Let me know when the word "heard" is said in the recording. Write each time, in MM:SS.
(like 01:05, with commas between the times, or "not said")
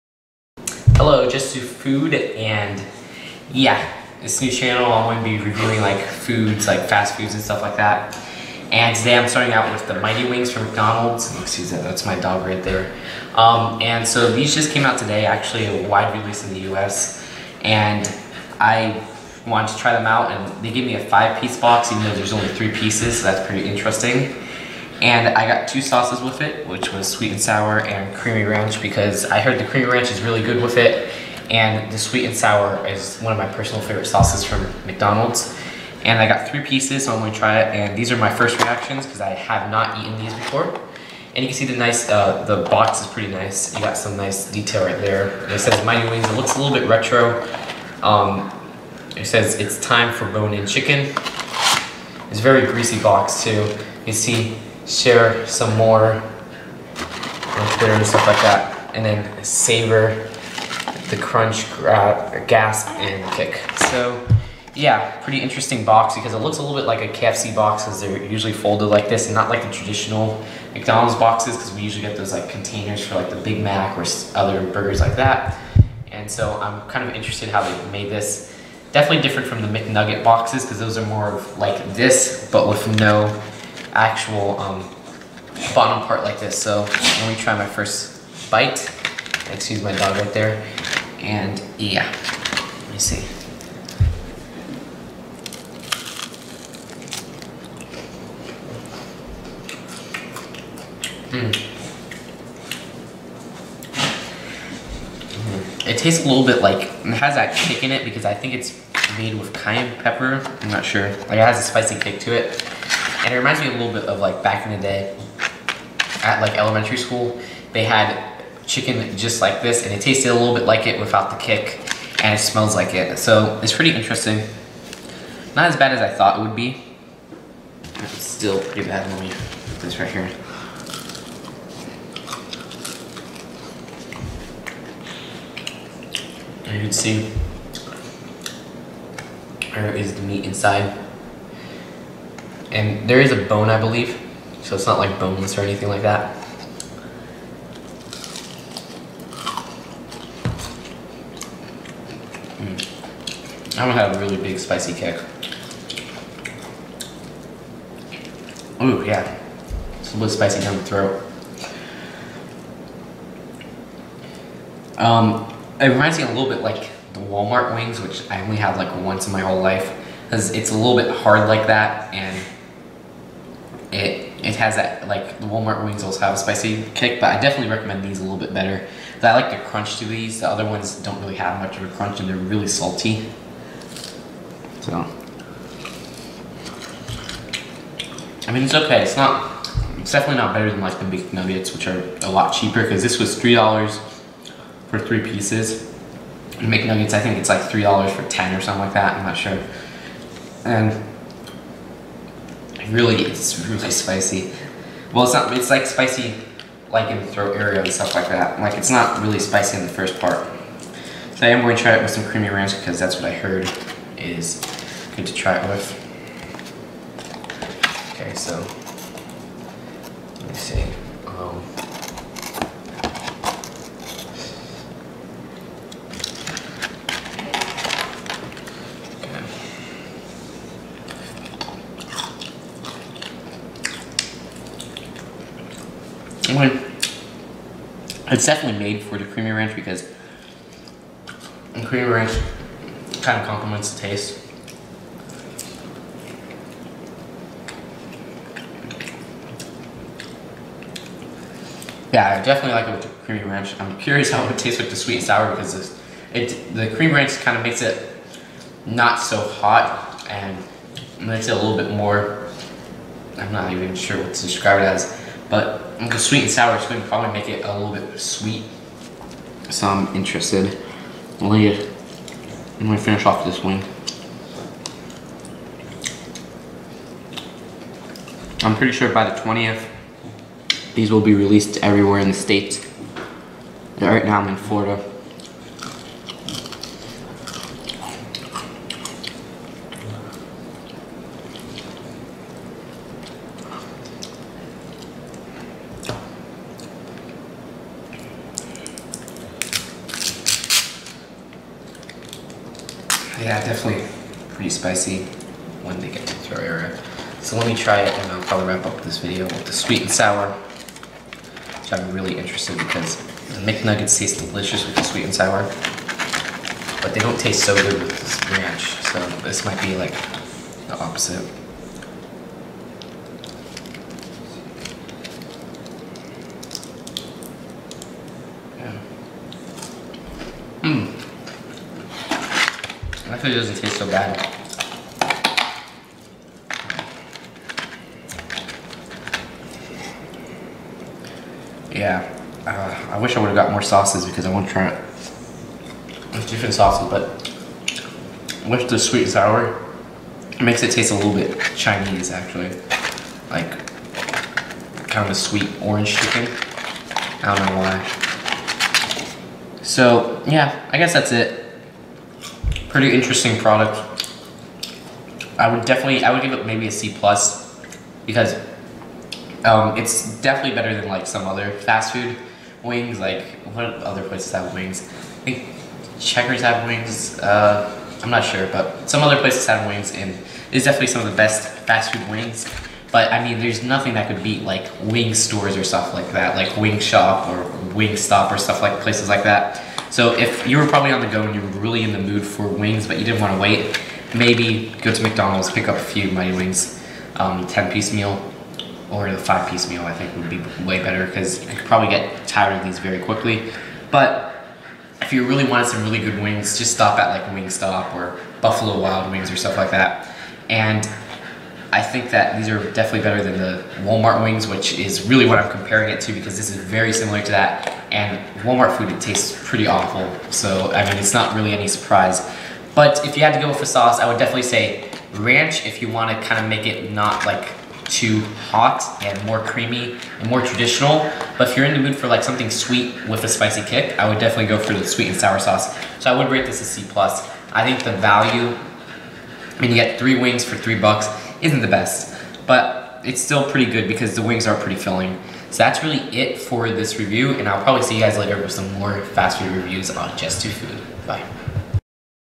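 00:29, 03:33.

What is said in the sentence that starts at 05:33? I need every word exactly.
Hopefully it doesn't taste so bad.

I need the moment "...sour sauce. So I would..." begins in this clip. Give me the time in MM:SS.
07:15.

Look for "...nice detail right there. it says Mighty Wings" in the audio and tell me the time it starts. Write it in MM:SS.
00:44.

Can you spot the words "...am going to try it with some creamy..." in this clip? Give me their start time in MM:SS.
03:31.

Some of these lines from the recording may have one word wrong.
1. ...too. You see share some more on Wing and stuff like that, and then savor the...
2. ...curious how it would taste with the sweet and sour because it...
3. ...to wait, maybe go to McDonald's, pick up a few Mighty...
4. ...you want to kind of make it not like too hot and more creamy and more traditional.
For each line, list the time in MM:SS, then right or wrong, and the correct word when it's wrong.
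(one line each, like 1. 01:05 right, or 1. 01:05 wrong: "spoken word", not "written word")
1. 00:53 wrong: "Twitter", not "Wing"
2. 04:13 right
3. 06:33 right
4. 07:06 right.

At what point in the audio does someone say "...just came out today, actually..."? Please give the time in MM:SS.
00:14.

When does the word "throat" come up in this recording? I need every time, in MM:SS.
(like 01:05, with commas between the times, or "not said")
02:40, 03:27.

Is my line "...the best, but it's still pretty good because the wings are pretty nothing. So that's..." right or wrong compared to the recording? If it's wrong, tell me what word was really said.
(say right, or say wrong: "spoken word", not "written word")
wrong: "filling", not "nothing".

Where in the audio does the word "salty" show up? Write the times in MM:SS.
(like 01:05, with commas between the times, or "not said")
03:02.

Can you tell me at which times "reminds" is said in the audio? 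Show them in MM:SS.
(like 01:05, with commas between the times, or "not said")
01:53, 02:45.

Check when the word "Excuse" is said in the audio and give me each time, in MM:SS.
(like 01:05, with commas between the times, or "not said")
00:11, 01:29.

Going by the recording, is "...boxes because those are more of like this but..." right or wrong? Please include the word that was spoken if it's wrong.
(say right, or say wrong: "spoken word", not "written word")
right.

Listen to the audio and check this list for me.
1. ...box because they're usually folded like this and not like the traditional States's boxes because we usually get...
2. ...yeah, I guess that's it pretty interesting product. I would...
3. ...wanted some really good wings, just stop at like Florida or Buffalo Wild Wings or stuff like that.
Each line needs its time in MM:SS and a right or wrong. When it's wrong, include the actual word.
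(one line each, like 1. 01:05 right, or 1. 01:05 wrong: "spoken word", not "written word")
1. 01:07 wrong: "McDonald", not "States"
2. 06:00 right
3. 06:45 wrong: "Wingstop", not "Florida".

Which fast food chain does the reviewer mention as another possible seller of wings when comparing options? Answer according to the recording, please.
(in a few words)
Checkers.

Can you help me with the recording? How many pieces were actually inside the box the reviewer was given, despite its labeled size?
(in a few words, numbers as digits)
3.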